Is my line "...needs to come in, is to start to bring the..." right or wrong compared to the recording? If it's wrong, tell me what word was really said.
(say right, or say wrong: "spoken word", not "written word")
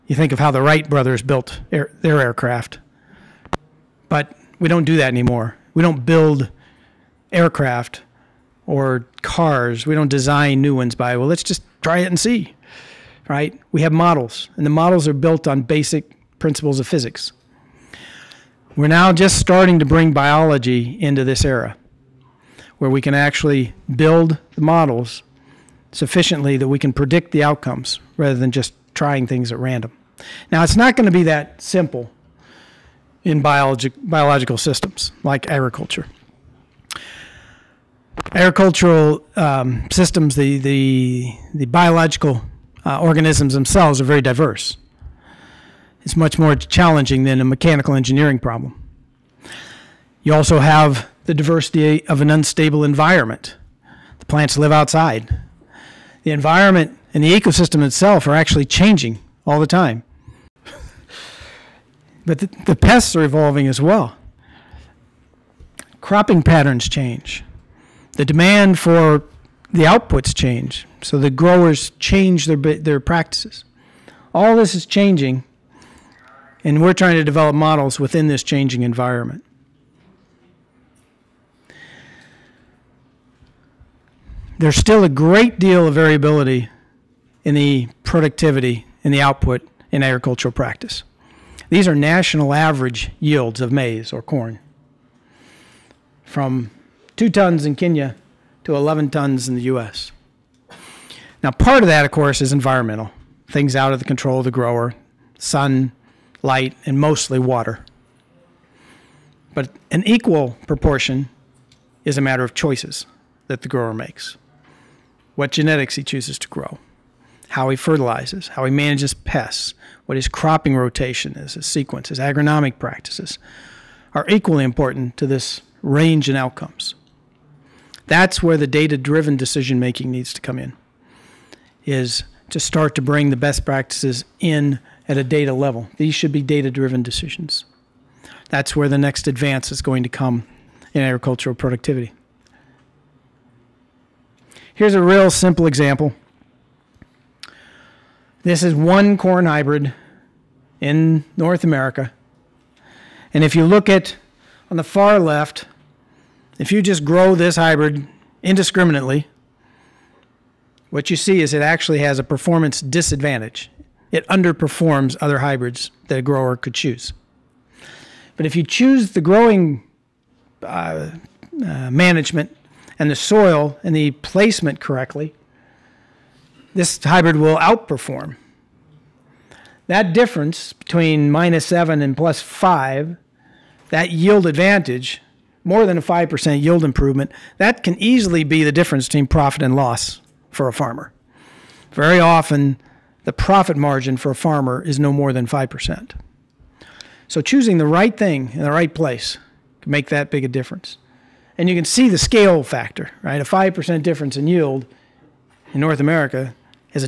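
right.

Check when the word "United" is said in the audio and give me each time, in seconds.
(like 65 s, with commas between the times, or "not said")
not said.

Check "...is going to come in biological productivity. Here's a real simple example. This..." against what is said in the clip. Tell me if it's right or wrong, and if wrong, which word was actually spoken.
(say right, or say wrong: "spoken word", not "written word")
wrong: "agricultural", not "biological".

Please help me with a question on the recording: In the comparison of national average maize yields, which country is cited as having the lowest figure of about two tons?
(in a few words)
Kenya.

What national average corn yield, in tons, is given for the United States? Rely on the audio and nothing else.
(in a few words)
11 tons.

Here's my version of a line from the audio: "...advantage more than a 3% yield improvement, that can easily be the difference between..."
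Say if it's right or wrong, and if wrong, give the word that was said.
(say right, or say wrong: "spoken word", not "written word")
wrong: "5", not "3".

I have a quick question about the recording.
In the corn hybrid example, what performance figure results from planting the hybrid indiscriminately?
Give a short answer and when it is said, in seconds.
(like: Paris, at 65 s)
-7, at 181 s.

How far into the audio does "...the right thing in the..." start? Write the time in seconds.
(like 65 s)
197 s.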